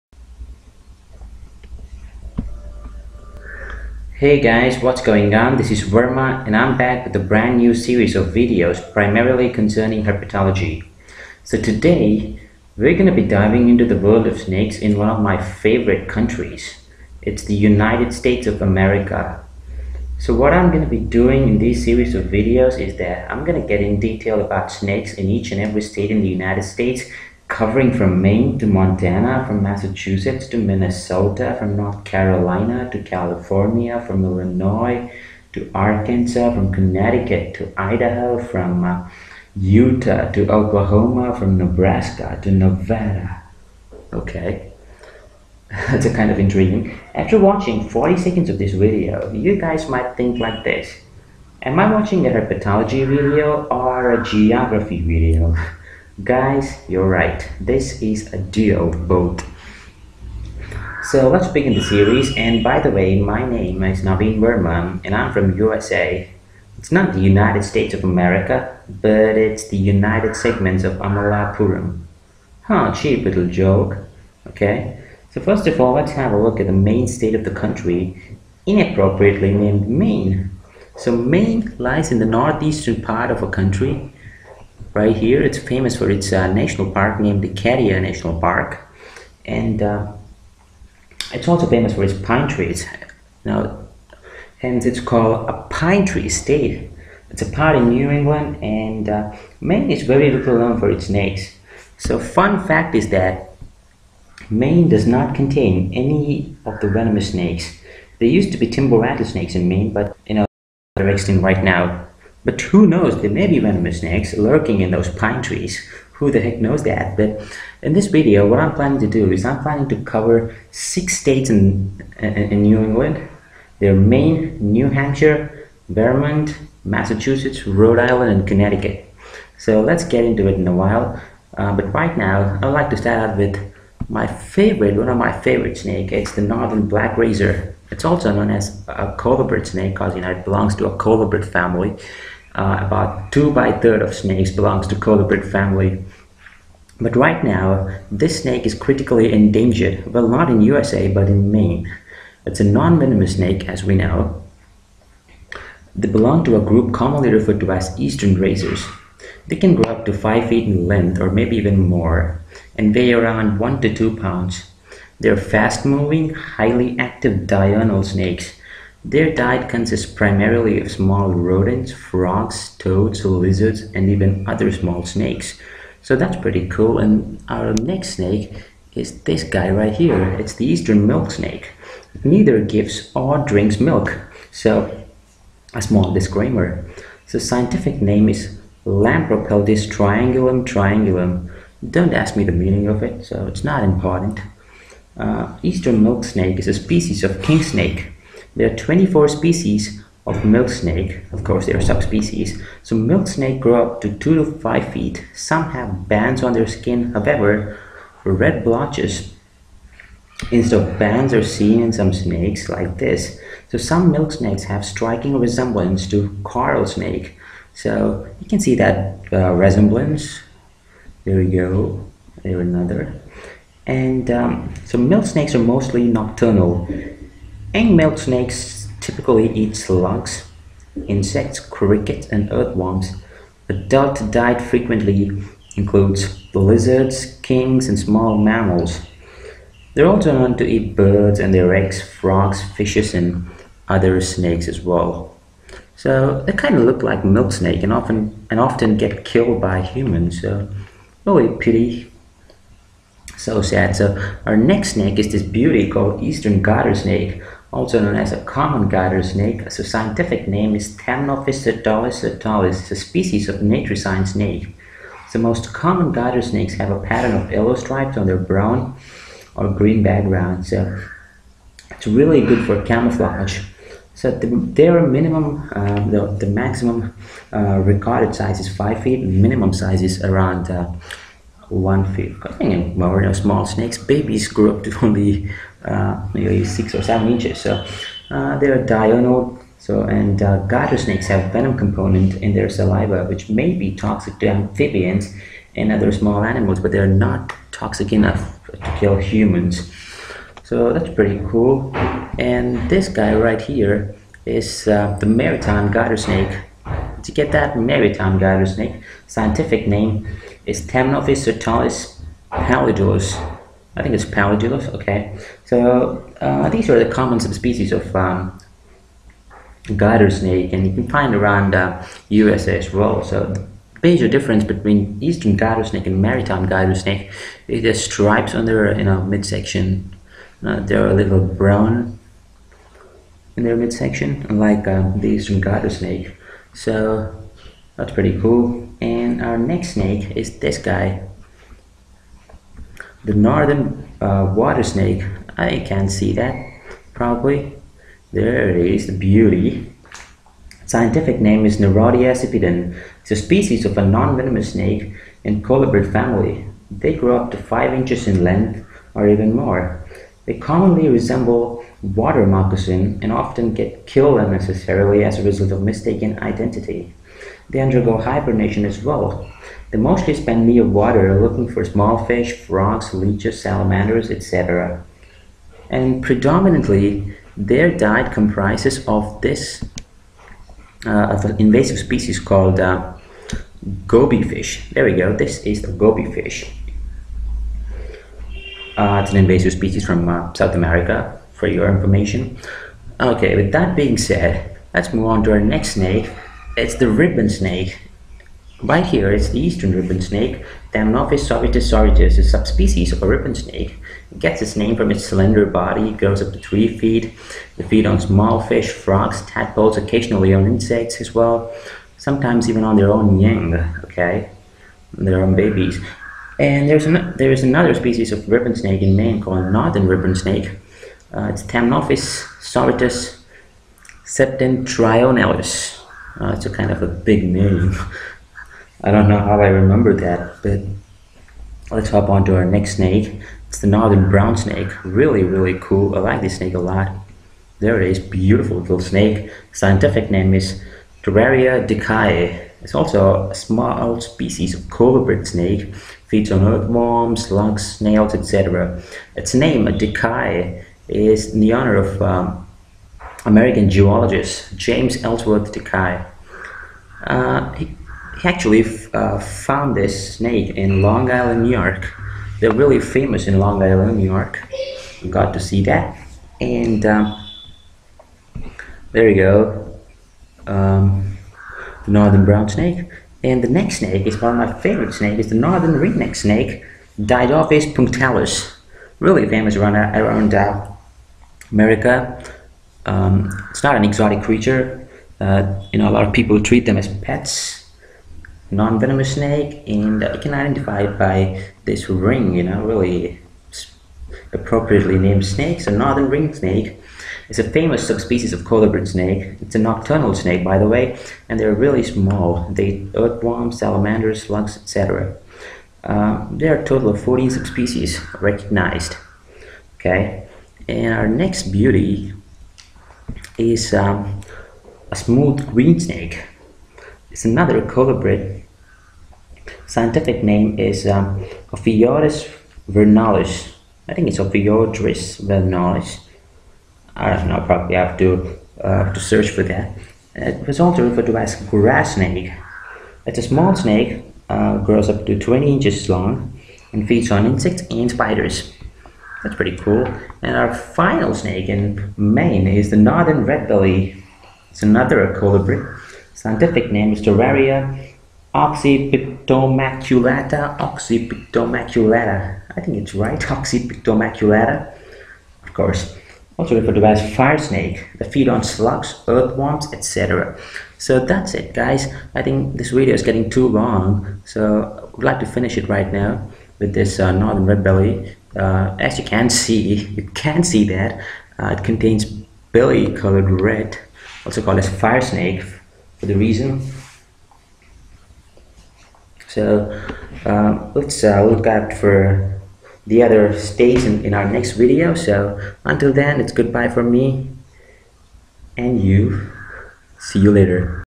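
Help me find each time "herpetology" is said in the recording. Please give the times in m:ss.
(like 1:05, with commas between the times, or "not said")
0:10, 0:52.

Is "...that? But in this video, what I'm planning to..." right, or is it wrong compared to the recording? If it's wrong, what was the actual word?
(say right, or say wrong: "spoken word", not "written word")
right.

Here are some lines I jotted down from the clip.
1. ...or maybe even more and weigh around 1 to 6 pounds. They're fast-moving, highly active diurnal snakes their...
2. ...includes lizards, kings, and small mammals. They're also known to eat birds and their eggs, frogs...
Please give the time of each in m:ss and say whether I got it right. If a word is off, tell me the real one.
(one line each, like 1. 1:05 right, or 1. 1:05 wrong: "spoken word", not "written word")
1. 2:41 wrong: "2", not "6"
2. 3:55 right.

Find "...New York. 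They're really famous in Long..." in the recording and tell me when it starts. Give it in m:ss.
7:41.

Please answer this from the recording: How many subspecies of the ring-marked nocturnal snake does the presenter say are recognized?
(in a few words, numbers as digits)
14.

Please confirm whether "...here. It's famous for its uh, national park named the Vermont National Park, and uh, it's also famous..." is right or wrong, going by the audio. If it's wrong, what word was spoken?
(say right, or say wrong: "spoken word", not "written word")
wrong: "Acadia", not "Vermont".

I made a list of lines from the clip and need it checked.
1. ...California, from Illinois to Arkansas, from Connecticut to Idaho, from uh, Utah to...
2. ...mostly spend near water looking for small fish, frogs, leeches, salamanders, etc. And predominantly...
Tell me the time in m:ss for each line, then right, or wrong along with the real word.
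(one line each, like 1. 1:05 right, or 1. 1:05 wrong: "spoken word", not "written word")
1. 0:33 right
2. 6:09 right.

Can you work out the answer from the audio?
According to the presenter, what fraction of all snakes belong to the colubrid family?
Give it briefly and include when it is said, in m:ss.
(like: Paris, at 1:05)
2/3, at 2:23.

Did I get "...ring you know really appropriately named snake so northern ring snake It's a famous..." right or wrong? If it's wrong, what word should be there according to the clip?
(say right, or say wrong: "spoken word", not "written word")
right.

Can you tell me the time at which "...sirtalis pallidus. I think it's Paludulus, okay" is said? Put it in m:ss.
5:11.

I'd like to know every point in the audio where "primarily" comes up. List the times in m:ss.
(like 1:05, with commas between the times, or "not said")
0:08, 2:50.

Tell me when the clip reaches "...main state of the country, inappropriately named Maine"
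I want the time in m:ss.
1:16.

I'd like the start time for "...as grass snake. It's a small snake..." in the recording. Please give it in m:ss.
8:51.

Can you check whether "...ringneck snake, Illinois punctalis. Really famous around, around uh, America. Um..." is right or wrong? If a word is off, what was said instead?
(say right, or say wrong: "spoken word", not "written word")
wrong: "Diadophis", not "Illinois".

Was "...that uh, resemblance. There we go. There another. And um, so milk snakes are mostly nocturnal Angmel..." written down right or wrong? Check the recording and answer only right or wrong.
right.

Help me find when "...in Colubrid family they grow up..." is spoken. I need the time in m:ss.
5:55.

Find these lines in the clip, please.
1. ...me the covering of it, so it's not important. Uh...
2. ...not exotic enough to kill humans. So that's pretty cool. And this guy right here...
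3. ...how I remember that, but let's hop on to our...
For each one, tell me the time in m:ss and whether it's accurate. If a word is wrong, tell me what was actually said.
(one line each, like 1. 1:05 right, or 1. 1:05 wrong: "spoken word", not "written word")
1. 3:12 wrong: "meaning", not "covering"
2. 4:57 wrong: "toxic", not "exotic"
3. 7:09 right.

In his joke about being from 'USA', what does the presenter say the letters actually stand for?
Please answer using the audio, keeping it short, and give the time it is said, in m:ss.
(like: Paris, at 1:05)
United Segments of Amalapuram, at 1:09.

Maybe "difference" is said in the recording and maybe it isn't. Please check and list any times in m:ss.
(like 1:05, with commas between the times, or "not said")
5:24.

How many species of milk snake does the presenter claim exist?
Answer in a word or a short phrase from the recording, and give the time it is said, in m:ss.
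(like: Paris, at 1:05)
24, at 3:18.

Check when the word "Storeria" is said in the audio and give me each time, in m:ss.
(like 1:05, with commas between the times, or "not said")
7:21, 9:07.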